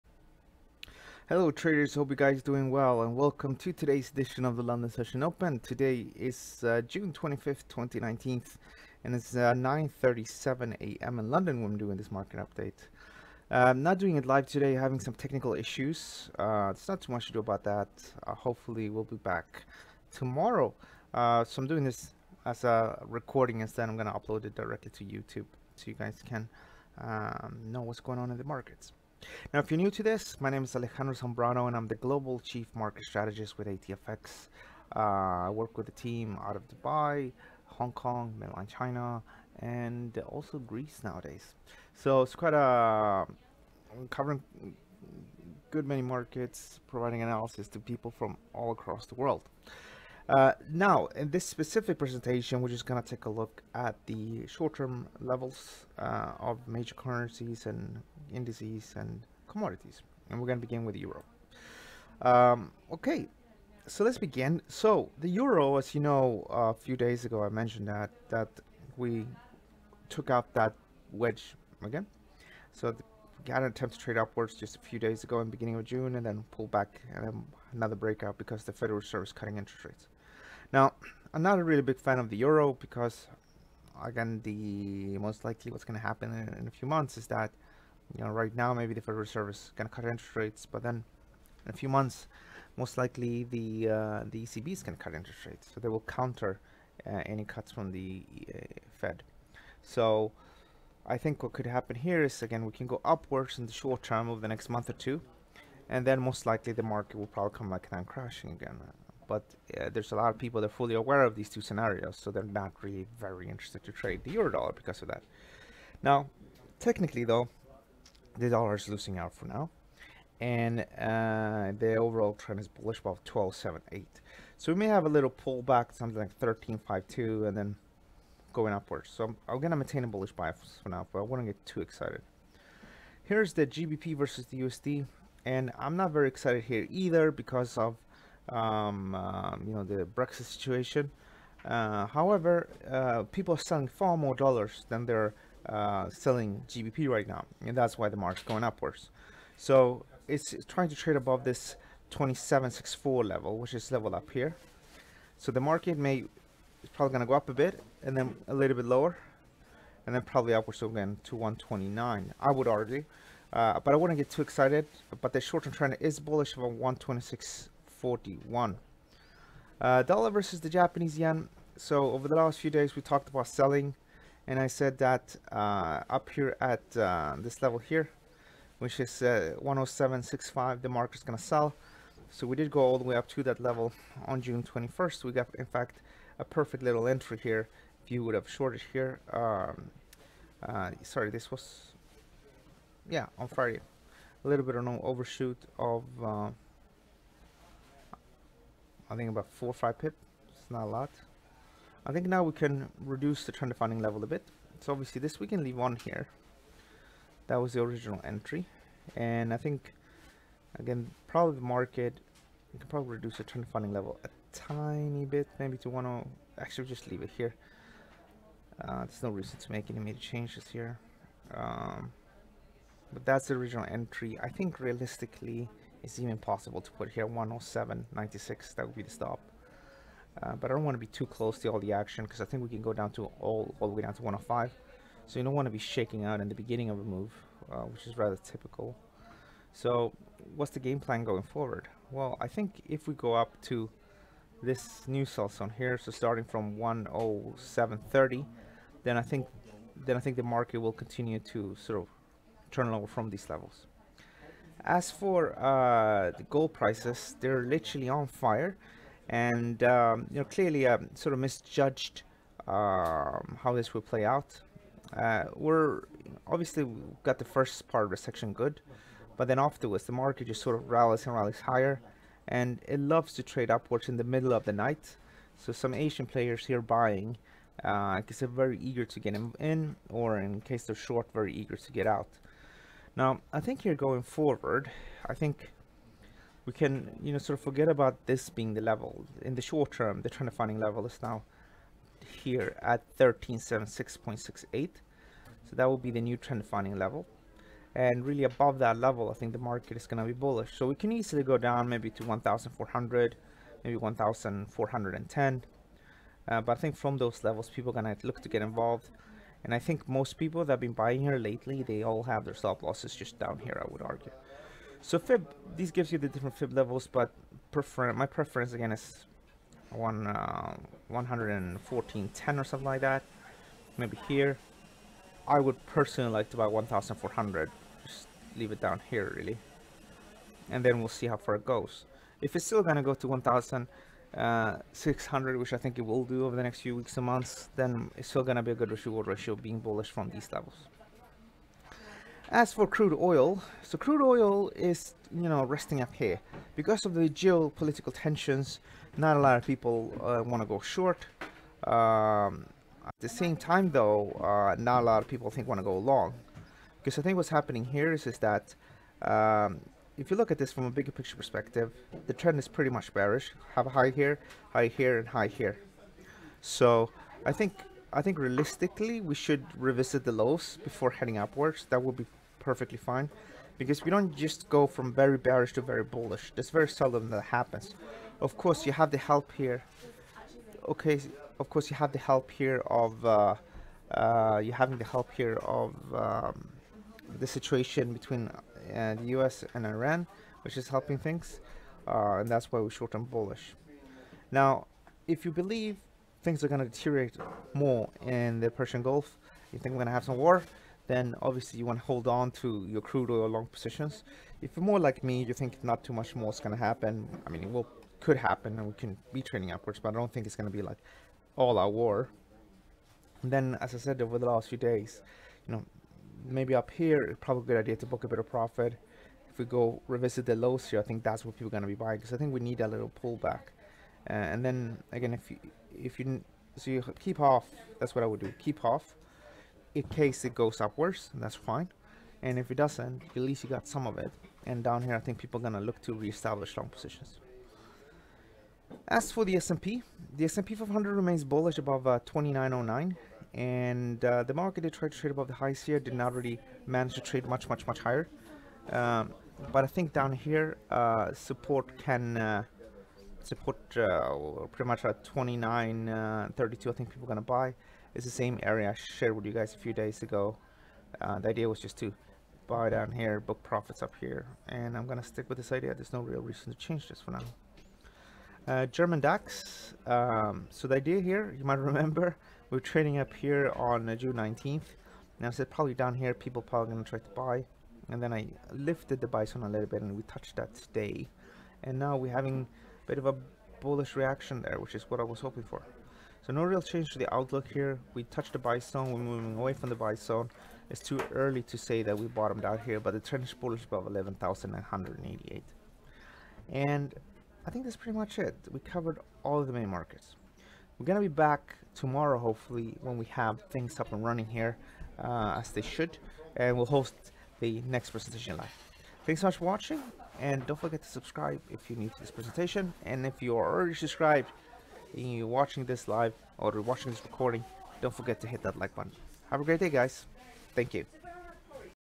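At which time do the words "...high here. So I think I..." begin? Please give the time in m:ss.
6:05.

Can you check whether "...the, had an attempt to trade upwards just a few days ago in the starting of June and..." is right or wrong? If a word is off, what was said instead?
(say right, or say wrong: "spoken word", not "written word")
wrong: "beginning", not "starting".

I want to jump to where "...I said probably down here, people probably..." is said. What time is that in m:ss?
7:55.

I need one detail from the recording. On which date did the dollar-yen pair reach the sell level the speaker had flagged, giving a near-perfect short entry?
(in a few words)
June 21st.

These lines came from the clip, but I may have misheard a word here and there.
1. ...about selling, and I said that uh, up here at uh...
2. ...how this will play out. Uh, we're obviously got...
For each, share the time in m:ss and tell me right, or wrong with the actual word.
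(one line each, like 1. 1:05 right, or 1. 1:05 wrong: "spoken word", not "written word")
1. 2:53 right
2. 4:23 right.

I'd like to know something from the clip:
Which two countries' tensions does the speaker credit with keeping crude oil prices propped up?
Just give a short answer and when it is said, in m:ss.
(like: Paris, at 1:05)
US and Iran, at 6:29.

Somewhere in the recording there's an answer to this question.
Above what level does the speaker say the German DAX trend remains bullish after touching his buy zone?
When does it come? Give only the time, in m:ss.
8:14.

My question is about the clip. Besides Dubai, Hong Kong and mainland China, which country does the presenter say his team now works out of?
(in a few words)
Greece.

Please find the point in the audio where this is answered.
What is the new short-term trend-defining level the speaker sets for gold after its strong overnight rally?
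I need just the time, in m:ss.
4:53.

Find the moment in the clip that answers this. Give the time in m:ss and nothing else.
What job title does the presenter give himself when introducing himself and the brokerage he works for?
0:31.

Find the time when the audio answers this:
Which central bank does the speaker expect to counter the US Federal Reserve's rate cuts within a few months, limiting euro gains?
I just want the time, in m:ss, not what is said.
1:34.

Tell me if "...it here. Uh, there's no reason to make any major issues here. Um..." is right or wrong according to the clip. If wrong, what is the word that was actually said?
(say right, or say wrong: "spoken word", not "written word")
wrong: "changes", not "issues".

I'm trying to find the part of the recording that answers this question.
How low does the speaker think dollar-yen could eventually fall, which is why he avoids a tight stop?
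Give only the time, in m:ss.
3:54.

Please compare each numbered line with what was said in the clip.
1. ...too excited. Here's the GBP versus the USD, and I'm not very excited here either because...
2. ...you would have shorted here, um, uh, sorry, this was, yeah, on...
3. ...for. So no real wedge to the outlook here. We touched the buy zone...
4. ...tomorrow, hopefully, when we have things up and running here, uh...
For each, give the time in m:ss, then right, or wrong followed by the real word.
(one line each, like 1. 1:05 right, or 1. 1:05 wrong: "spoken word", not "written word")
1. 2:11 right
2. 3:08 right
3. 8:05 wrong: "change", not "wedge"
4. 8:21 right.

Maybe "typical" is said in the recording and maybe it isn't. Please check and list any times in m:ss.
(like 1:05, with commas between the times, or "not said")
3:58.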